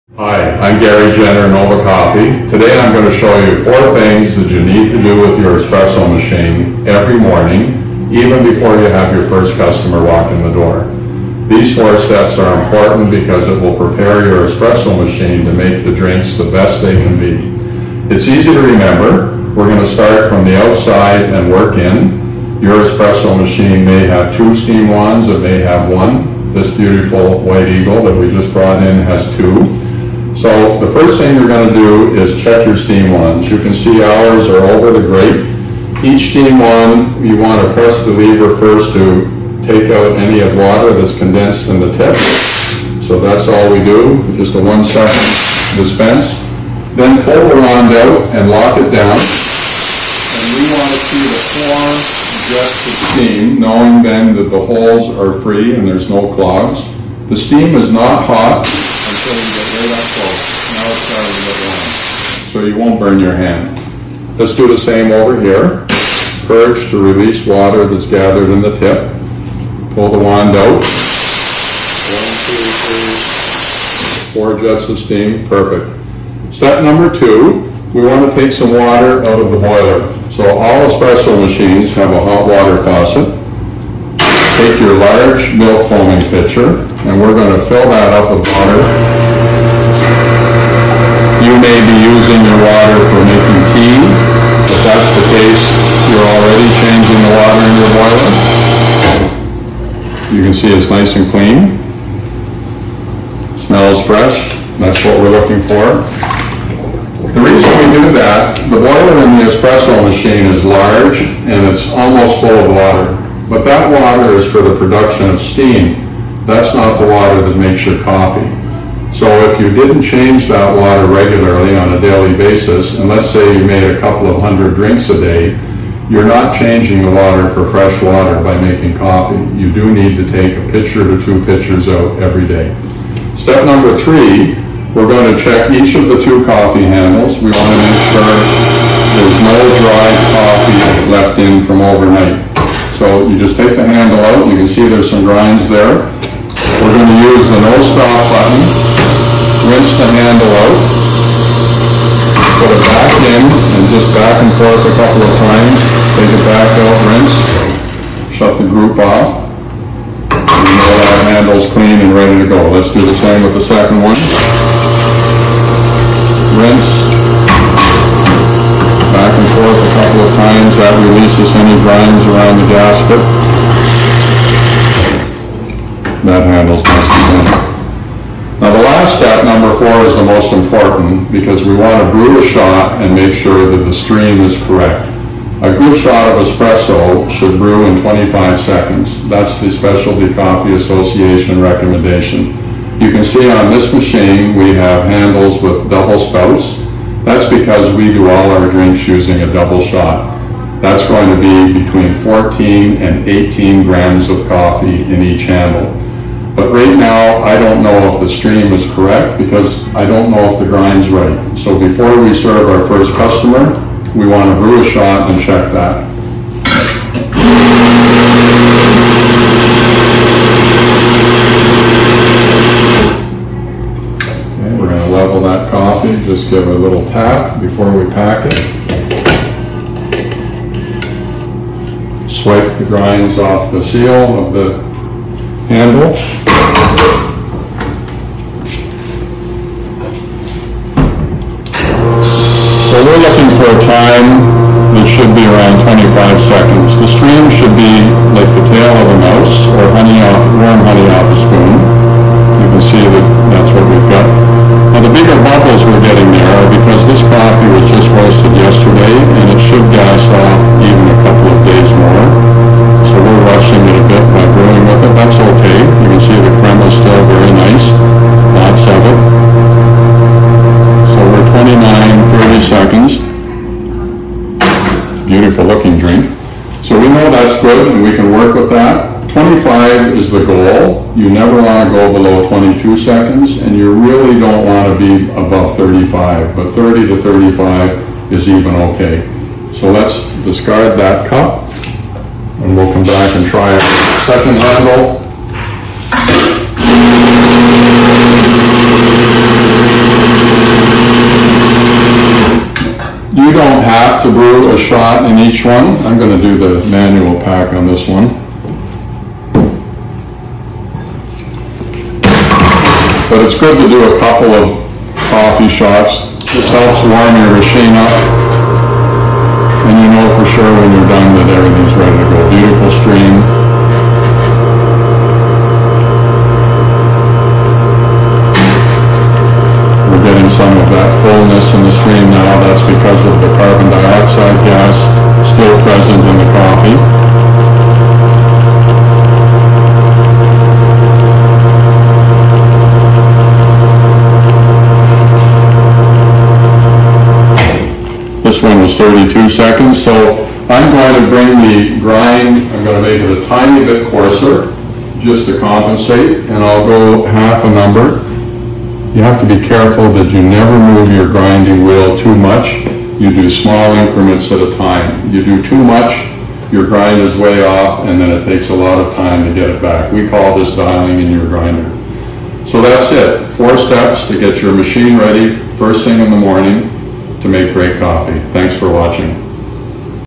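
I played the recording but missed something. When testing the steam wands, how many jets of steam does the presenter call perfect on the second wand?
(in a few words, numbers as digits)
4.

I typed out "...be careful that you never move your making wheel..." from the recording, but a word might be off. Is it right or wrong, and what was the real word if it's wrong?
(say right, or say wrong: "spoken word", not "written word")
wrong: "grinding", not "making".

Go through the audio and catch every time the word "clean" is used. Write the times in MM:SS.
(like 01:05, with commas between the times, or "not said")
01:41, 02:41, 02:57.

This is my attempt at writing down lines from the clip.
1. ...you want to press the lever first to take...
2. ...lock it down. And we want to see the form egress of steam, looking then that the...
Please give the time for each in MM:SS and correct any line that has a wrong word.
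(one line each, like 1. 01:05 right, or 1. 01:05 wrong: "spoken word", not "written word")
1. 00:37 right
2. 00:48 wrong: "knowing", not "looking".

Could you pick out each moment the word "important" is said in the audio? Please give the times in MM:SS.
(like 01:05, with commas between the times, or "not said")
00:12, 03:00.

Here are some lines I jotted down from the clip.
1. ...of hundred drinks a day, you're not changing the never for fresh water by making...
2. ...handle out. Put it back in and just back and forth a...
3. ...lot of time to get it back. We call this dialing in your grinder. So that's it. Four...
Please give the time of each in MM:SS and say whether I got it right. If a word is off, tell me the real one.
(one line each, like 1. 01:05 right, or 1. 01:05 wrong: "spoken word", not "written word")
1. 02:04 wrong: "water", not "never"
2. 02:30 right
3. 06:08 right.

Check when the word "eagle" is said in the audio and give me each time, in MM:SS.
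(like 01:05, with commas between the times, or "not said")
00:27.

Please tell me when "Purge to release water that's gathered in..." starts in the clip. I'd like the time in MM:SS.
01:06.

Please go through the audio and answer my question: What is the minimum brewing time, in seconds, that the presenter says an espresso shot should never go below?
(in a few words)
22 seconds.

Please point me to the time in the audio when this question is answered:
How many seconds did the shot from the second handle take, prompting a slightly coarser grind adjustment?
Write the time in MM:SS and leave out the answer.
05:48.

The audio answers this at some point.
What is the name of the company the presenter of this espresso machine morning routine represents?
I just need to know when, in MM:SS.
00:01.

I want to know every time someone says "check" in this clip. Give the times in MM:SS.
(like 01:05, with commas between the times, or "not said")
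00:32, 02:15, 03:35.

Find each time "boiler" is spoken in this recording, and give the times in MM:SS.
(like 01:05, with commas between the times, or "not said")
01:19, 01:37, 01:48.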